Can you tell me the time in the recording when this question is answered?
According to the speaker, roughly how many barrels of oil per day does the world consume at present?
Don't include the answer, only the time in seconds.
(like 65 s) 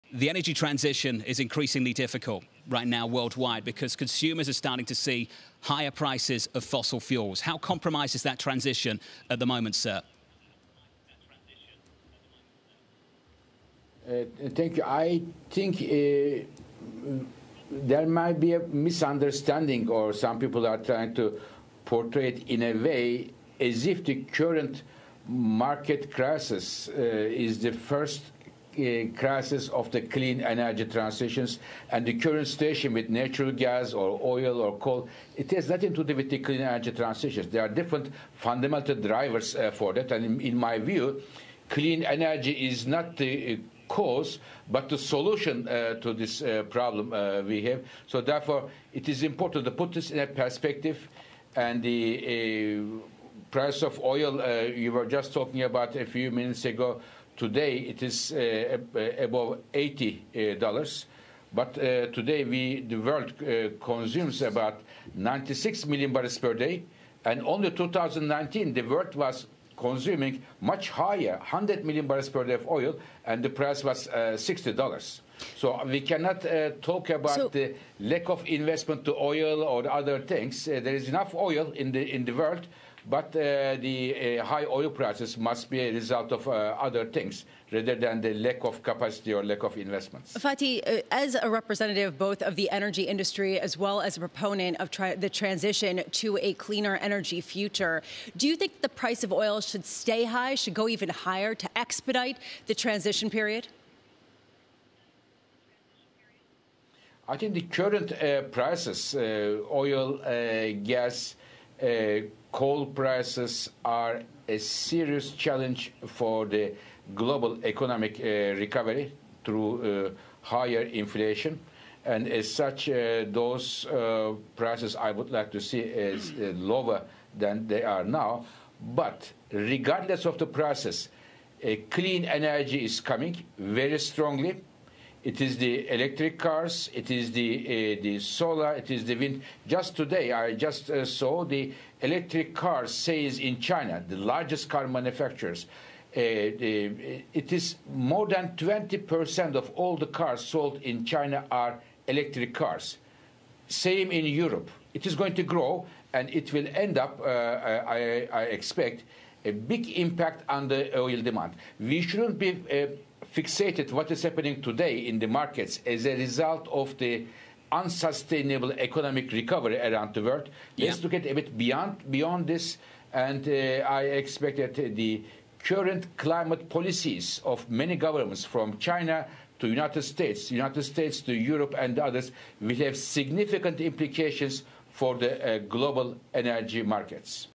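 65 s.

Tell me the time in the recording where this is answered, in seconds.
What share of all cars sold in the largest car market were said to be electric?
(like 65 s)
147 s.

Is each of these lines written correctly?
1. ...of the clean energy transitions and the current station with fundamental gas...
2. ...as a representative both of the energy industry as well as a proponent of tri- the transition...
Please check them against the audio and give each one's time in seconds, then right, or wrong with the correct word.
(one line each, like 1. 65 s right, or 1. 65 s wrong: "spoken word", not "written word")
1. 29 s wrong: "natural", not "fundamental"
2. 91 s right.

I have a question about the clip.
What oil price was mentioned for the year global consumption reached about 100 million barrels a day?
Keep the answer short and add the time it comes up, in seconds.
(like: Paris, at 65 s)
$60, at 74 s.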